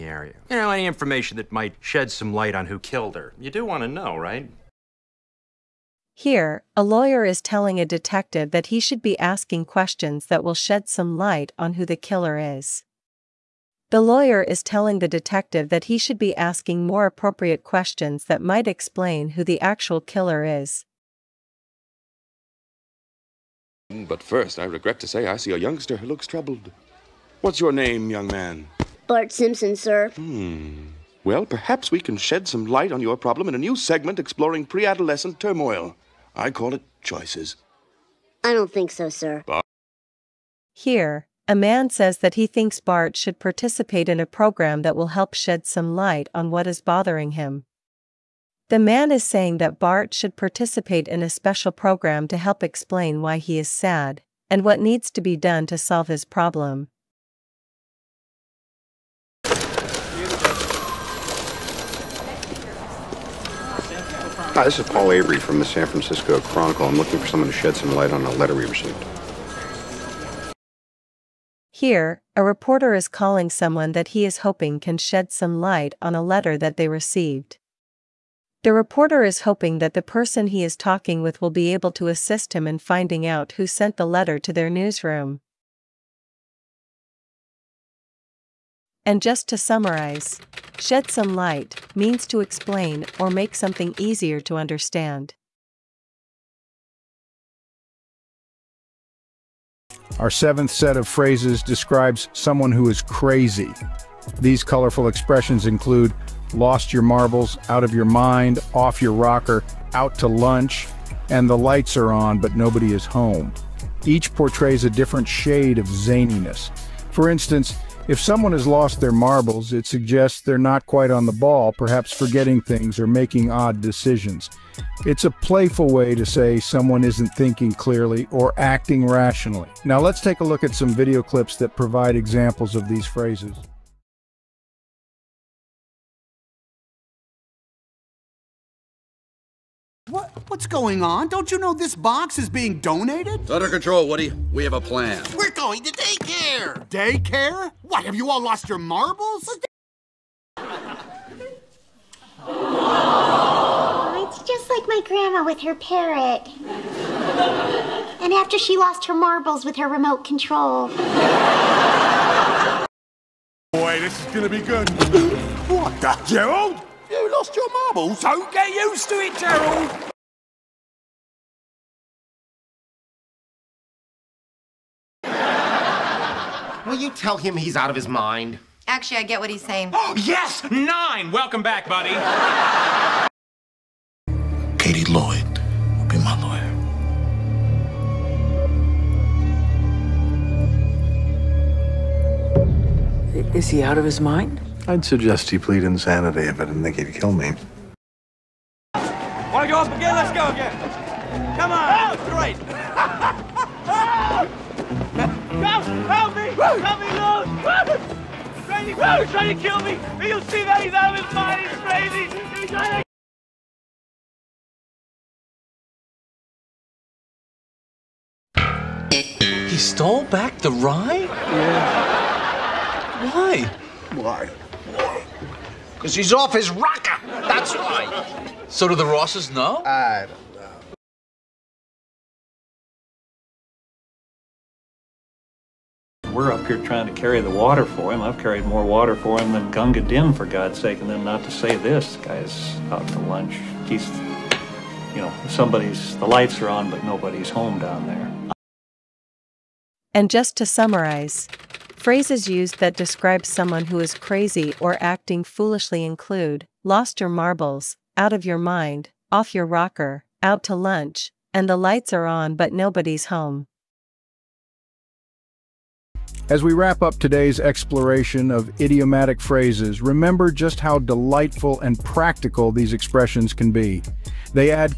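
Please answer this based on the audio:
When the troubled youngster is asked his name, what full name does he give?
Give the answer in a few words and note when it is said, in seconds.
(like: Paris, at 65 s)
Bart Simpson, at 29 s.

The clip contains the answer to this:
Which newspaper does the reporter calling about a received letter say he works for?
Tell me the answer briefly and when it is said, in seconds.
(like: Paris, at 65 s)
San Francisco Chronicle, at 65 s.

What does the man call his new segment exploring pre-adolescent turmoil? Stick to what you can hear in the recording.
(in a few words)
Choices.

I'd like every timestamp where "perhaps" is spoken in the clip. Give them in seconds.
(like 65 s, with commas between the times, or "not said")
31 s, 121 s.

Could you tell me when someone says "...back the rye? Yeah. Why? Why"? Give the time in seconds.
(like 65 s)
220 s.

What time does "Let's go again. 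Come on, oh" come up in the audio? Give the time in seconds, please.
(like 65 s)
200 s.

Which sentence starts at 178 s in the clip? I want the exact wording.
Actually, I get what he's saying.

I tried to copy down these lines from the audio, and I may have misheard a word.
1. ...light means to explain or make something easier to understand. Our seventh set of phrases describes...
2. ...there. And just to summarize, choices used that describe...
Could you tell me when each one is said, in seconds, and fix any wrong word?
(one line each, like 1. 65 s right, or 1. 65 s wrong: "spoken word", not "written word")
1. 91 s right
2. 248 s wrong: "phrases", not "choices".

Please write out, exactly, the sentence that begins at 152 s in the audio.
Oh, it's just like my grandma with her parrot.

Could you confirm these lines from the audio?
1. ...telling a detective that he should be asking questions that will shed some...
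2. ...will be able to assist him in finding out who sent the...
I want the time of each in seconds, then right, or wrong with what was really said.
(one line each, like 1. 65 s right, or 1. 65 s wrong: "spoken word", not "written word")
1. 7 s right
2. 81 s right.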